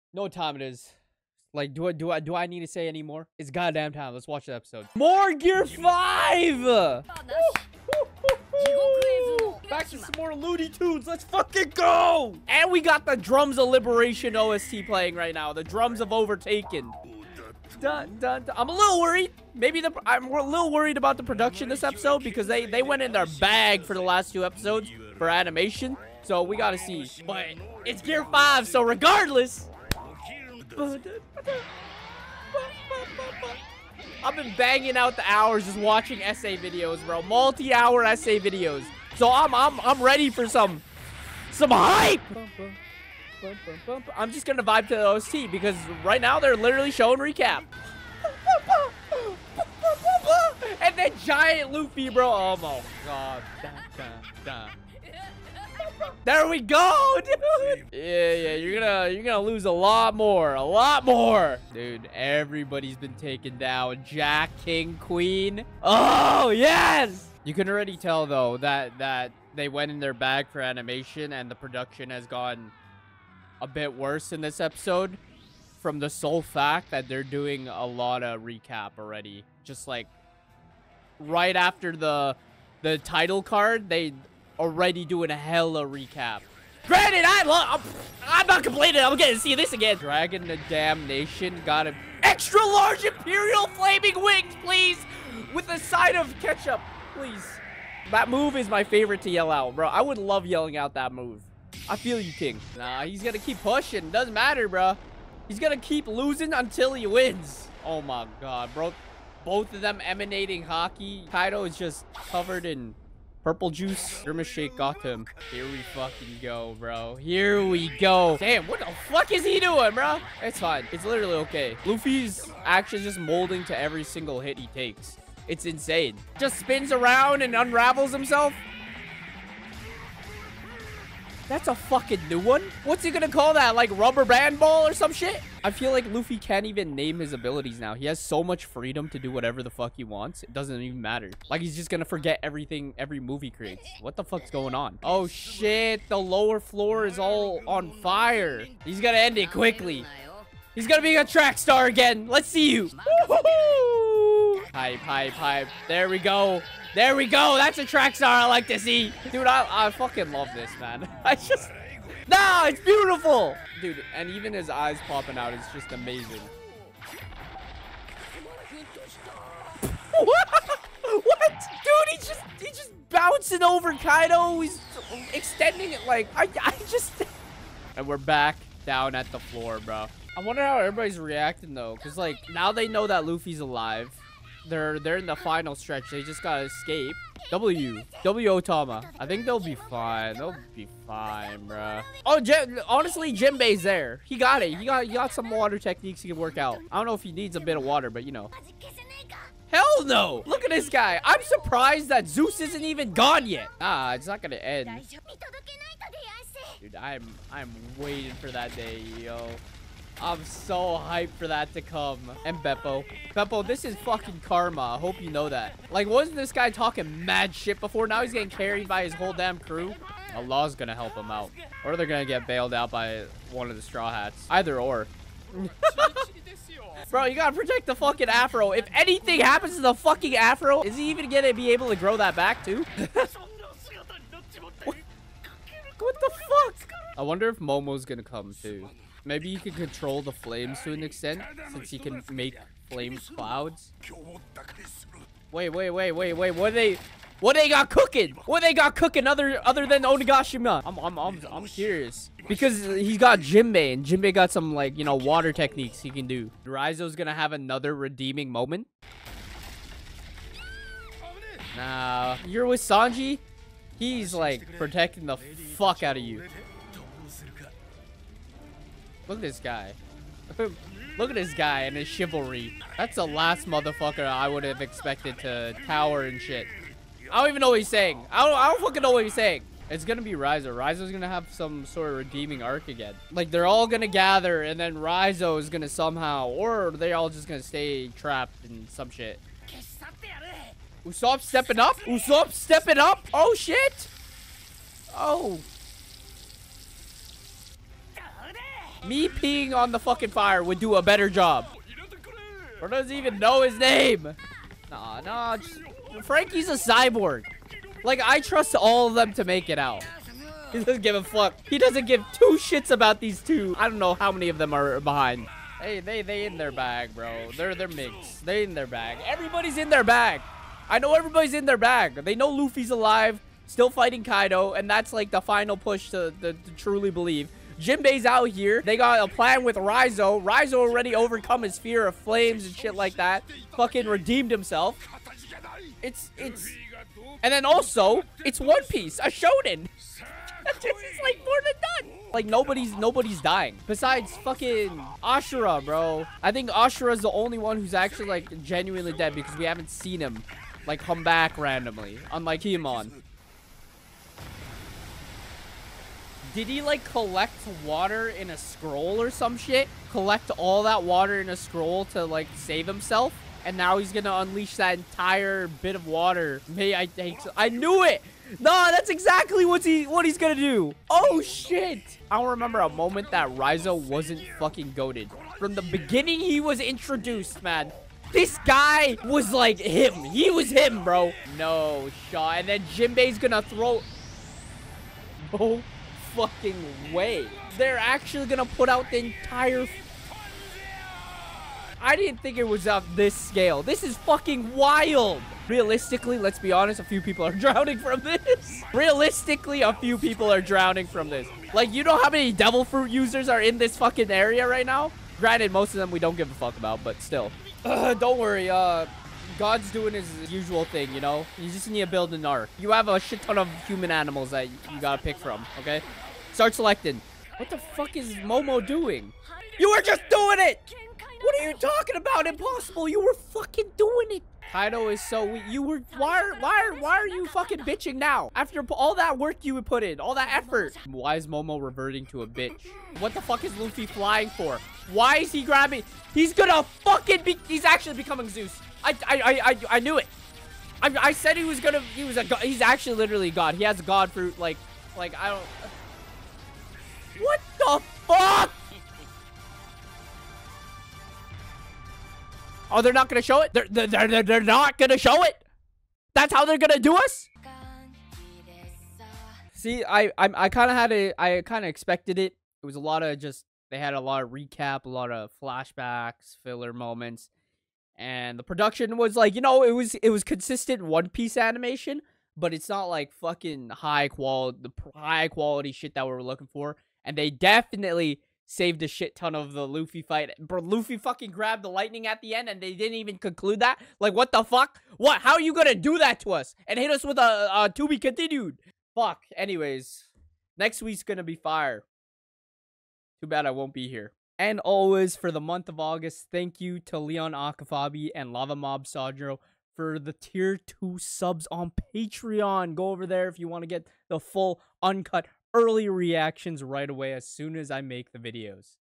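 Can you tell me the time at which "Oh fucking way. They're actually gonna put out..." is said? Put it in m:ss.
6:25.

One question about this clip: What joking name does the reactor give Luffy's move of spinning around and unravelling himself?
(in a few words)
Rubber band ball.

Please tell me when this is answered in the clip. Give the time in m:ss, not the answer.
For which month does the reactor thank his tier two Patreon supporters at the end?
8:15.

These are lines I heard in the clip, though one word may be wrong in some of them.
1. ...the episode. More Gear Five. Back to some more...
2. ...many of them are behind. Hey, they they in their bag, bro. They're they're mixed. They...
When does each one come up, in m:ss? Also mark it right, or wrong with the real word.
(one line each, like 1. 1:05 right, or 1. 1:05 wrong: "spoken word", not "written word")
1. 0:04 right
2. 5:14 right.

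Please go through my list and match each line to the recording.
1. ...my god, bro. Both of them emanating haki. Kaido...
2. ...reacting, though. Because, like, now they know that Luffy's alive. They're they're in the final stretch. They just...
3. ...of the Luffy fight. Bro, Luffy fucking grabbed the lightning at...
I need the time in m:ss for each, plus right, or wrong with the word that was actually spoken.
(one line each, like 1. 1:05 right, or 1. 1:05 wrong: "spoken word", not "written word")
1. 1:48 right
2. 3:01 right
3. 7:59 right.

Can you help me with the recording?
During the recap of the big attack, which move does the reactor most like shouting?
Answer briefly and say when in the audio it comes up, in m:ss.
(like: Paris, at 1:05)
Imperial Flaming Wings, at 1:33.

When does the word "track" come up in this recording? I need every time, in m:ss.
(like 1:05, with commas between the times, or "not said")
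2:31, 2:37.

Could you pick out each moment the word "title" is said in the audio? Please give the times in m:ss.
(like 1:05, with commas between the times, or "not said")
1:22.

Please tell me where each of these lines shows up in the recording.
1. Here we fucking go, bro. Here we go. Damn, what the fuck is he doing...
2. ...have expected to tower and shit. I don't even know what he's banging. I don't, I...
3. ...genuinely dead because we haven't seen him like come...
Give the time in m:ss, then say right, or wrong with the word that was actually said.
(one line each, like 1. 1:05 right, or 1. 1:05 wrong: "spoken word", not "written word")
1. 1:55 right
2. 4:34 wrong: "saying", not "banging"
3. 5:48 right.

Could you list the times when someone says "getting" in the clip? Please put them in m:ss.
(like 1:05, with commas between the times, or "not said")
1:29, 3:38.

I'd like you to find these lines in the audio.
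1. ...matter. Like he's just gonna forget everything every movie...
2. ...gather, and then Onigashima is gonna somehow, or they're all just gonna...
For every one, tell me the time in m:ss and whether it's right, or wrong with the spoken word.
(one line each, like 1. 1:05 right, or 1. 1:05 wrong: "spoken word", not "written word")
1. 2:21 right
2. 4:44 wrong: "Raizo", not "Onigashima".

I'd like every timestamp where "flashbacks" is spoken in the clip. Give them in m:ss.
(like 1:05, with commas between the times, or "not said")
7:45.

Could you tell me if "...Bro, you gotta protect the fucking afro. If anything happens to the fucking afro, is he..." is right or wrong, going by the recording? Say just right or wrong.
right.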